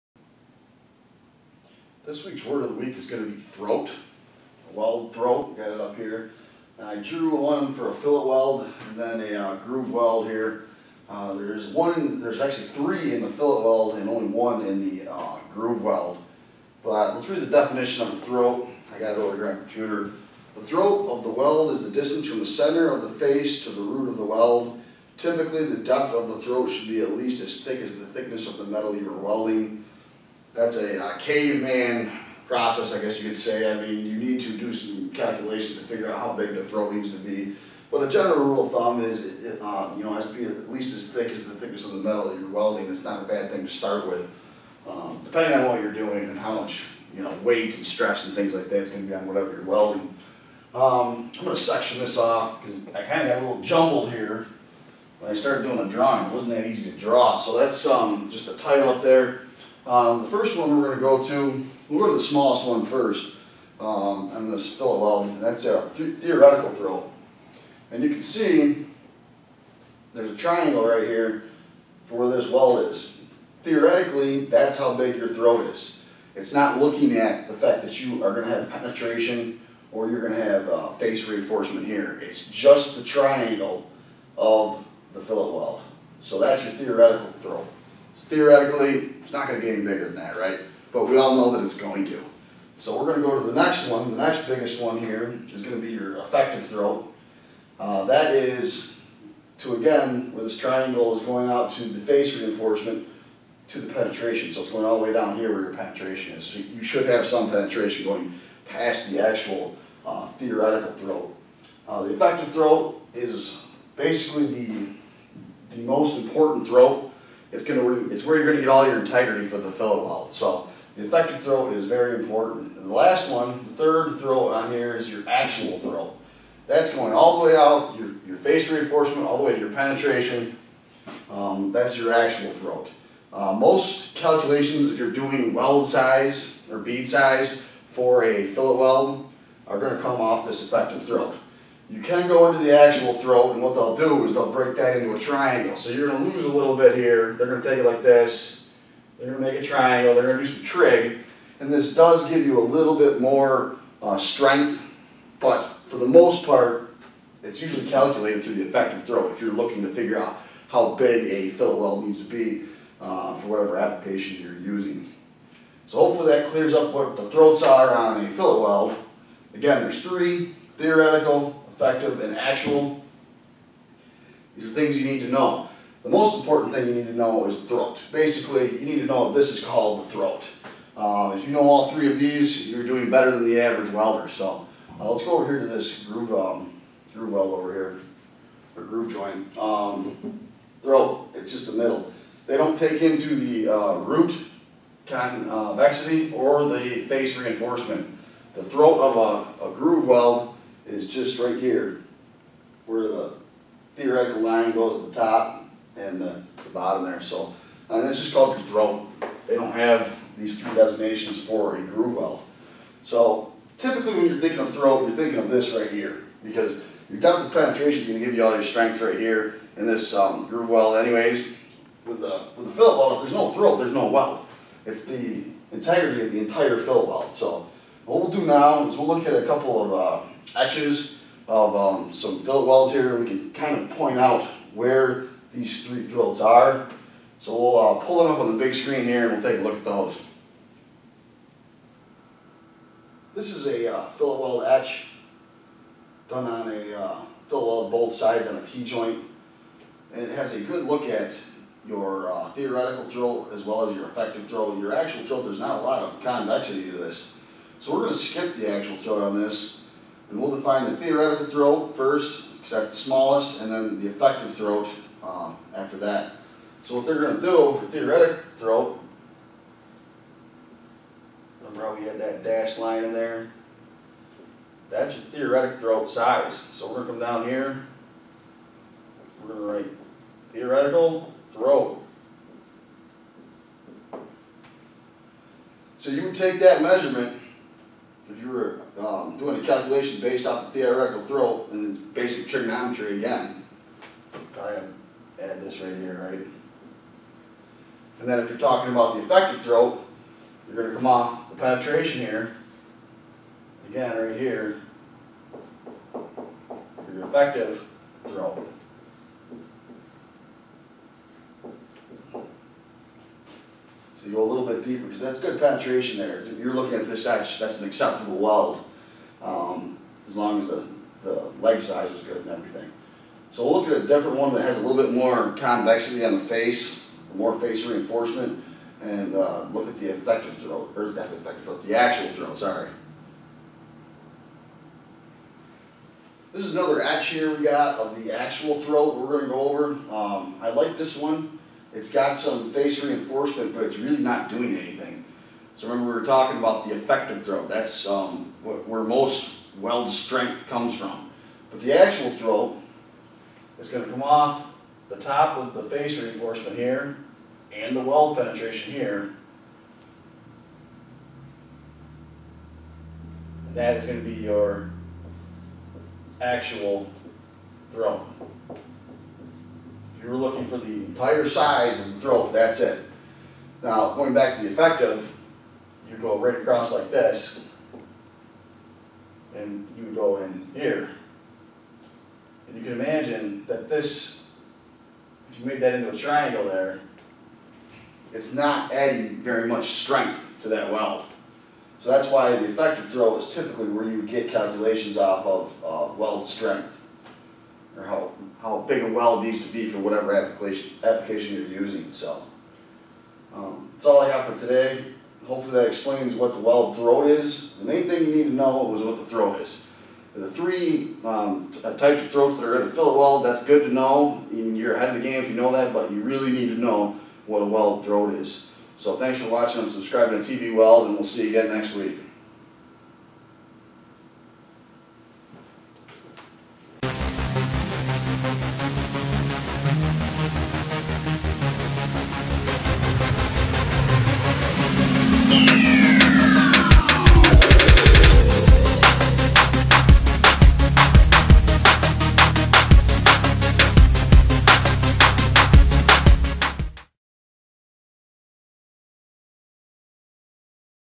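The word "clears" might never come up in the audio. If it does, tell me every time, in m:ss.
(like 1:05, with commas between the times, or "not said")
2:46.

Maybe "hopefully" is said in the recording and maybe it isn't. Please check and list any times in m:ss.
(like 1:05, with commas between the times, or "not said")
2:45, 6:45.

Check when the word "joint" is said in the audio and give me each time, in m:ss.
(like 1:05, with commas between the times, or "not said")
3:09, 4:08.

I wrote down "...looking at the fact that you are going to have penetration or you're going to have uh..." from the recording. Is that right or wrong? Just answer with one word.
right.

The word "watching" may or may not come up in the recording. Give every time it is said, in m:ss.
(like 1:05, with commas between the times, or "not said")
6:59.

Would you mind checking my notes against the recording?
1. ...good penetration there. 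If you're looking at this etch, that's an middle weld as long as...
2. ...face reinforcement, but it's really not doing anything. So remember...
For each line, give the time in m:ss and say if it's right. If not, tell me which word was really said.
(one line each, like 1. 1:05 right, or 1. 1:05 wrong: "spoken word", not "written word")
1. 5:15 wrong: "acceptable", not "middle"
2. 5:42 right.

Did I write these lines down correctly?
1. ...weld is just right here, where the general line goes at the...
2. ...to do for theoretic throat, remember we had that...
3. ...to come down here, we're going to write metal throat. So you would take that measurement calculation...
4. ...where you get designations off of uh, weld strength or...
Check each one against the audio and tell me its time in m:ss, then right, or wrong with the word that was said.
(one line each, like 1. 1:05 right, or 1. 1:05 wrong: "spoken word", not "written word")
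1. 3:20 wrong: "theoretical", not "general"
2. 4:27 right
3. 4:37 wrong: "theoretical", not "metal"
4. 6:33 wrong: "calculations", not "designations".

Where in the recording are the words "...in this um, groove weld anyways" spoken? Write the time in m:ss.
3:39.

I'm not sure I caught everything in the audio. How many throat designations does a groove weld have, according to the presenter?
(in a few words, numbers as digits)
1.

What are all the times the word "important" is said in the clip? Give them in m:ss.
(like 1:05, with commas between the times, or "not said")
1:56, 2:02, 2:56.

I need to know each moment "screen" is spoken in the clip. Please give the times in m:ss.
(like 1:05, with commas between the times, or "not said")
3:58.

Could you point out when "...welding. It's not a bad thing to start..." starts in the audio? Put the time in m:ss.
0:42.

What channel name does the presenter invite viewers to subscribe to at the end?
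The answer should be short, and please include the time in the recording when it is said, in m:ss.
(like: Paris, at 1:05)
TV Weld, at 7:00.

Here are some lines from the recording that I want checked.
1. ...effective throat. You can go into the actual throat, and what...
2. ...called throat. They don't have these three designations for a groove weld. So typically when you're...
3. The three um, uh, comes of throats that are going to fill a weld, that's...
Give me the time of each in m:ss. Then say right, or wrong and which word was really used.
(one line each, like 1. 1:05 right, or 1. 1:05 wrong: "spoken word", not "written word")
1. 2:20 right
2. 3:28 right
3. 6:50 wrong: "types", not "comes".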